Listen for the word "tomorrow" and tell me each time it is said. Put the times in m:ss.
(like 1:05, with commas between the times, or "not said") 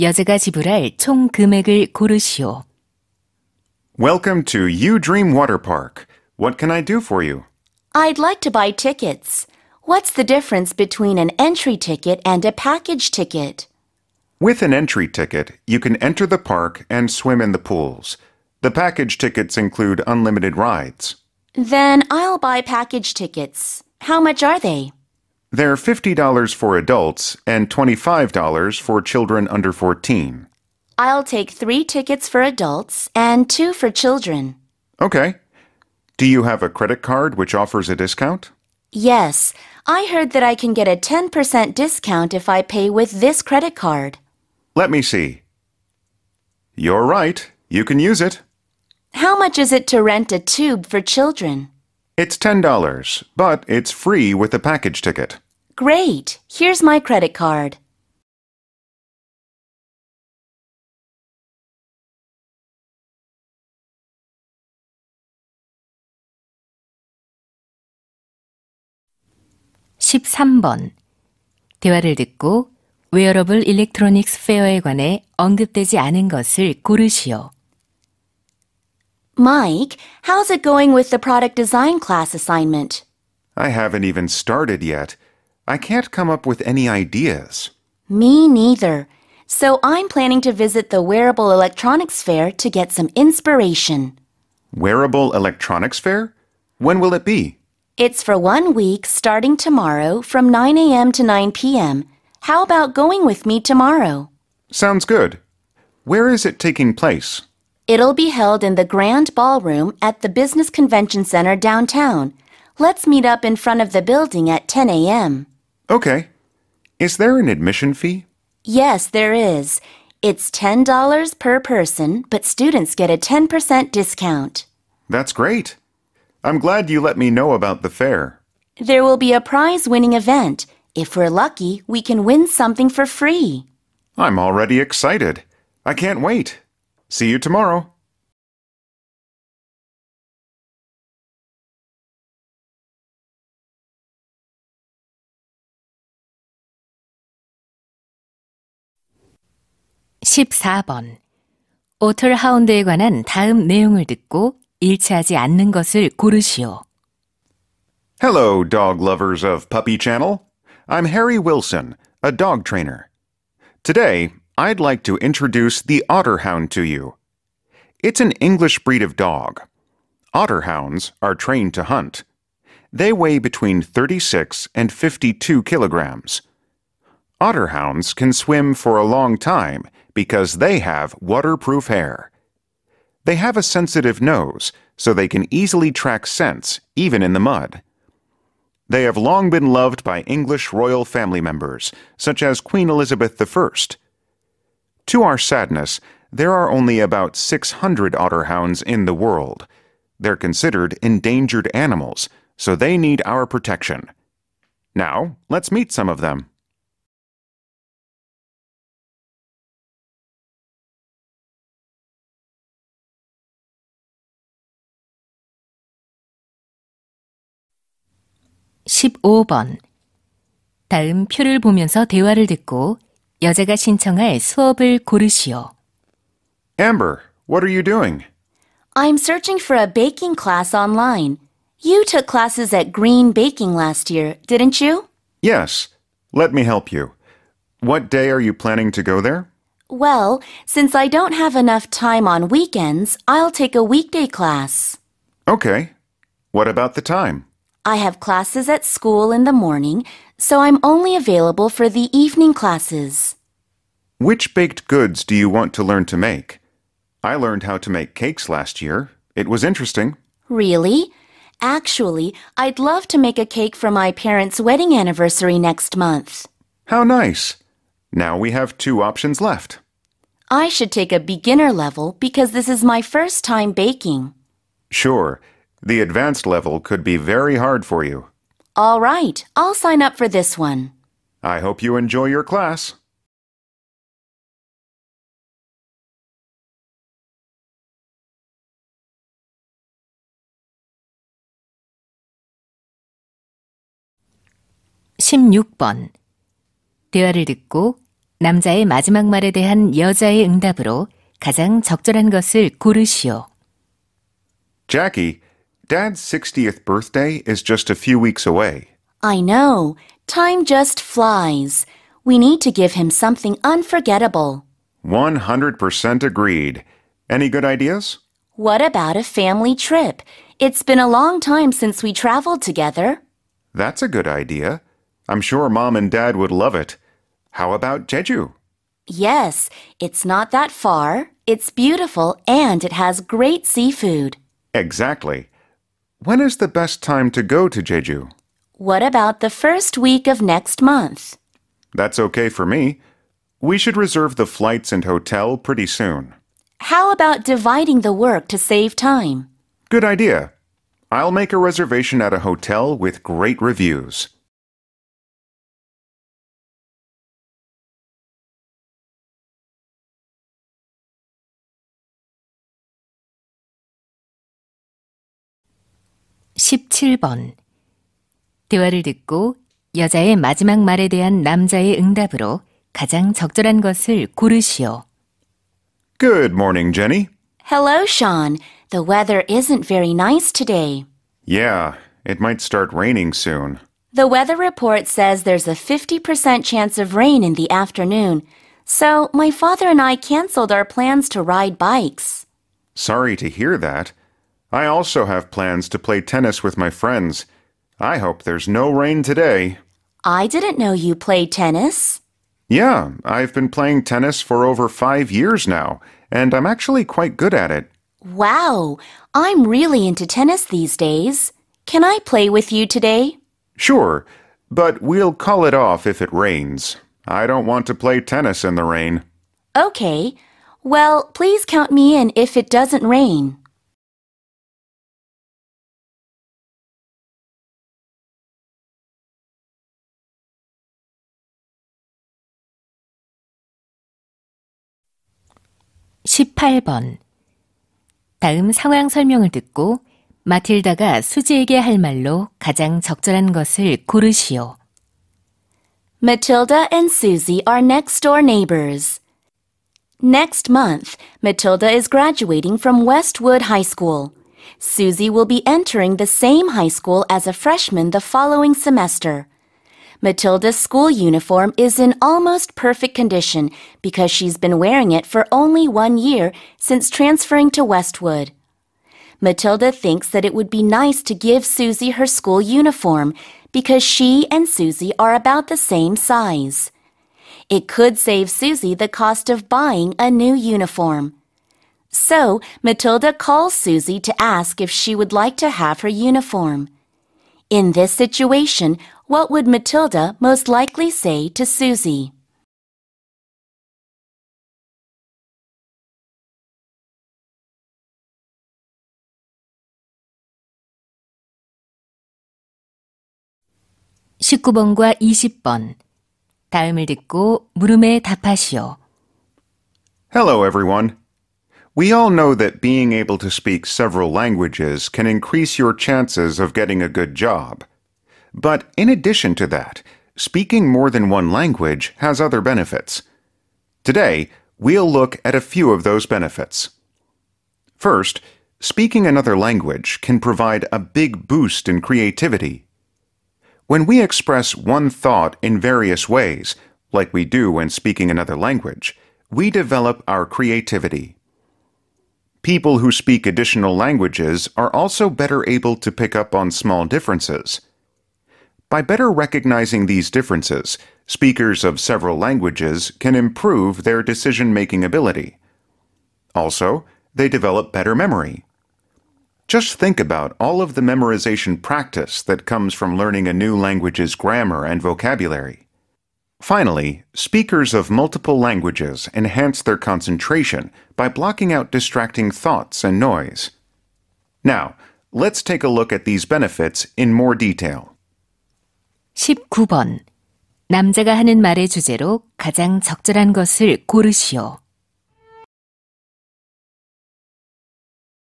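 1:39, 1:43, 2:17.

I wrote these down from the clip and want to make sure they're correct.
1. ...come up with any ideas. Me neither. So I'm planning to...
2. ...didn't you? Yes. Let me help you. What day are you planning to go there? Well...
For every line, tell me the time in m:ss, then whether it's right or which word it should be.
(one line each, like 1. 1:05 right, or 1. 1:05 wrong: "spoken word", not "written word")
1. 1:26 right
2. 3:54 right.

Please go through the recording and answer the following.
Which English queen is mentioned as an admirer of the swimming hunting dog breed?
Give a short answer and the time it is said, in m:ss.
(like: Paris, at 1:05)
Queen Elizabeth I, at 3:12.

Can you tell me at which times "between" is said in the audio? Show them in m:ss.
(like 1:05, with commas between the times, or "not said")
0:10, 2:53.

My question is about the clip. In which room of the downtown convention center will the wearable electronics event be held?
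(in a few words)
Grand Ballroom.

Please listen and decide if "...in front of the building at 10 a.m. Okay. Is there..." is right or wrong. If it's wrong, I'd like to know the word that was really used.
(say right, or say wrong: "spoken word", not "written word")
right.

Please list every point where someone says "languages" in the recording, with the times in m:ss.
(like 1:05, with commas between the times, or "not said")
8:34, 8:41, 8:49, 8:58, 9:03, 9:12, 9:23, 9:28.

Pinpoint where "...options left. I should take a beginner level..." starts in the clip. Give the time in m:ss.
4:28.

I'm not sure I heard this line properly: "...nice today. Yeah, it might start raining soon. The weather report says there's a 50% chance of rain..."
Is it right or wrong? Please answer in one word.
right.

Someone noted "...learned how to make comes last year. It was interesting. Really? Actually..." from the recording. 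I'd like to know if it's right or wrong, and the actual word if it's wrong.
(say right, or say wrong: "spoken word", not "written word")
wrong: "cakes", not "comes".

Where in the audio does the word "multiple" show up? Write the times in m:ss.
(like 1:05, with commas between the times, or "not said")
9:28.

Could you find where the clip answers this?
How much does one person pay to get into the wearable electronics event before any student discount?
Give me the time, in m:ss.
2:00.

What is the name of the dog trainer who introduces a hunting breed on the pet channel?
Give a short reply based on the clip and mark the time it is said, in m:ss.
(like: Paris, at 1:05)
Harry Wilson, at 2:41.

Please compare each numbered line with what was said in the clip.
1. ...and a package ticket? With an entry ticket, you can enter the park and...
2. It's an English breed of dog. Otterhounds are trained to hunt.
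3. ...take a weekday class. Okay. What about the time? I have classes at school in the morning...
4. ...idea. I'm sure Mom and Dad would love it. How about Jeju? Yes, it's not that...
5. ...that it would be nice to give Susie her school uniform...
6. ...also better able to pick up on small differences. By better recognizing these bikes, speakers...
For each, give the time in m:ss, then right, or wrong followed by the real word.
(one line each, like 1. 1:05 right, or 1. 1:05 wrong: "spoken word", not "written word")
1. 0:12 right
2. 2:48 right
3. 4:03 right
4. 5:24 right
5. 7:50 right
6. 9:04 wrong: "differences", not "bikes".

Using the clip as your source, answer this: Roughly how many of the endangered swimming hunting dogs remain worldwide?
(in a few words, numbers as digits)
600.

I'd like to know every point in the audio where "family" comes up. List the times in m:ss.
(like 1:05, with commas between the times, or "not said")
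3:11, 5:19.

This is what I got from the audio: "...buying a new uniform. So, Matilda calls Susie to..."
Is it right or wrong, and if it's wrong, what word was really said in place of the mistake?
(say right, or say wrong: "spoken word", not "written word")
right.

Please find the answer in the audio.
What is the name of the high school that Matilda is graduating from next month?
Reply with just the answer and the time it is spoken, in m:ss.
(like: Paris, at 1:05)
Westwood High School, at 7:33.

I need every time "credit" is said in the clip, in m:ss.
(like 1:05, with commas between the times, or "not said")
0:36, 0:43, 0:56.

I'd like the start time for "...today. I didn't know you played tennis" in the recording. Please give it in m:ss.
6:39.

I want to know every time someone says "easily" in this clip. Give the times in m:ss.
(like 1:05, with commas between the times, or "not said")
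3:05.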